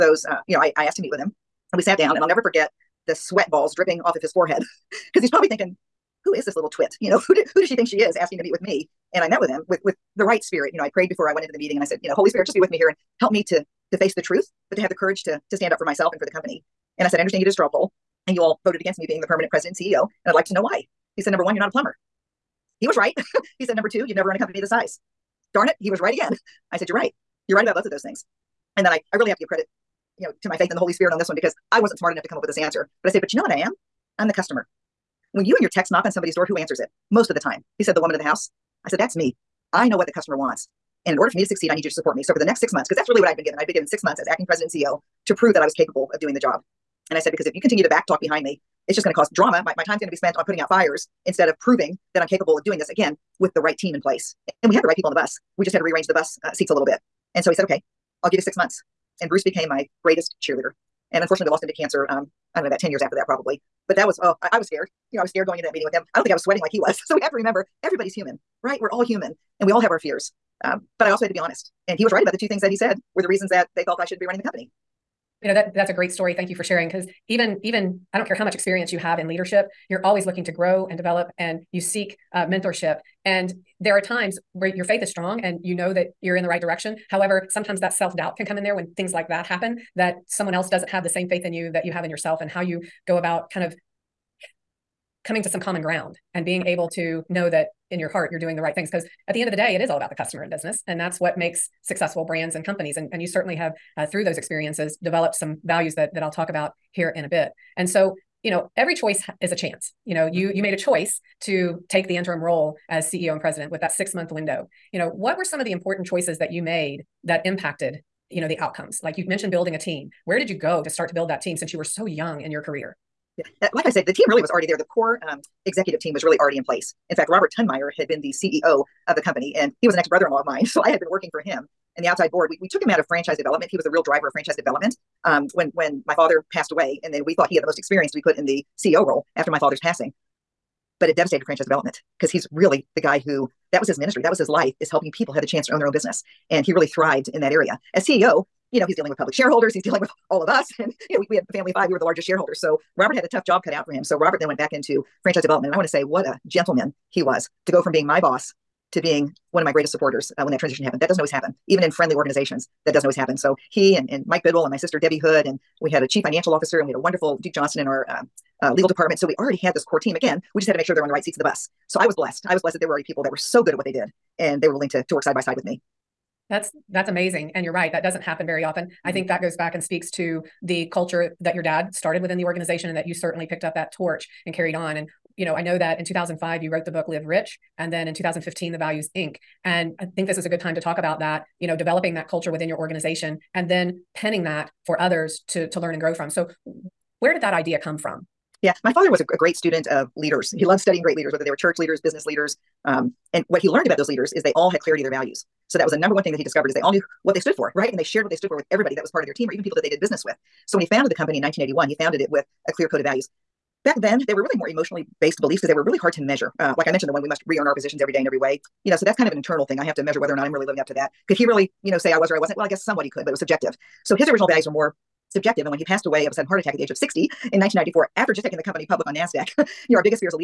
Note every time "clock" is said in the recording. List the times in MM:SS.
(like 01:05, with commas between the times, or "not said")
not said.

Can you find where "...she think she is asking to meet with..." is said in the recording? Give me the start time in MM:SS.
00:07.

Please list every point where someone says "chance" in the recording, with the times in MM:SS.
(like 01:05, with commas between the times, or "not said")
01:49, 02:25.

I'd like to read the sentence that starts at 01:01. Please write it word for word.
And unfortunately, we lost him to cancer.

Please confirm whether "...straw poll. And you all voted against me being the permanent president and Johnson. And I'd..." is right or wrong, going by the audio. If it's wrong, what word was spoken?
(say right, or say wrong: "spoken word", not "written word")
wrong: "CEO", not "Johnson".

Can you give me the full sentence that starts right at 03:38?
You know, so that's kind of an internal thing.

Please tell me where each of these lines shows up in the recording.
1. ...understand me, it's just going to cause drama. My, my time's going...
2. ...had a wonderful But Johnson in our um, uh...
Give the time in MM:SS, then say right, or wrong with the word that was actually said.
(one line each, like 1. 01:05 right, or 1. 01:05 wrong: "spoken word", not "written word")
1. 00:48 wrong: "behind", not "understand"
2. 02:46 wrong: "Duke", not "But".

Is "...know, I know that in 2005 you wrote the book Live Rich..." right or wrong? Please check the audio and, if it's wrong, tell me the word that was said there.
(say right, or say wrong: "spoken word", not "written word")
right.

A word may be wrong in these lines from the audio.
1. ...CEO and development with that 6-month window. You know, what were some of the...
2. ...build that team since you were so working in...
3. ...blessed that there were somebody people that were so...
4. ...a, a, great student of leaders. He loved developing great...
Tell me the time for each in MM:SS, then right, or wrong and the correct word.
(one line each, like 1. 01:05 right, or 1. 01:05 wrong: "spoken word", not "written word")
1. 01:53 wrong: "president", not "development"
2. 02:01 wrong: "young", not "working"
3. 02:52 wrong: "already", not "somebody"
4. 03:19 wrong: "studying", not "developing".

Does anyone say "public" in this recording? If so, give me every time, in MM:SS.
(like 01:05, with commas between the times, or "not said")
02:29, 03:48.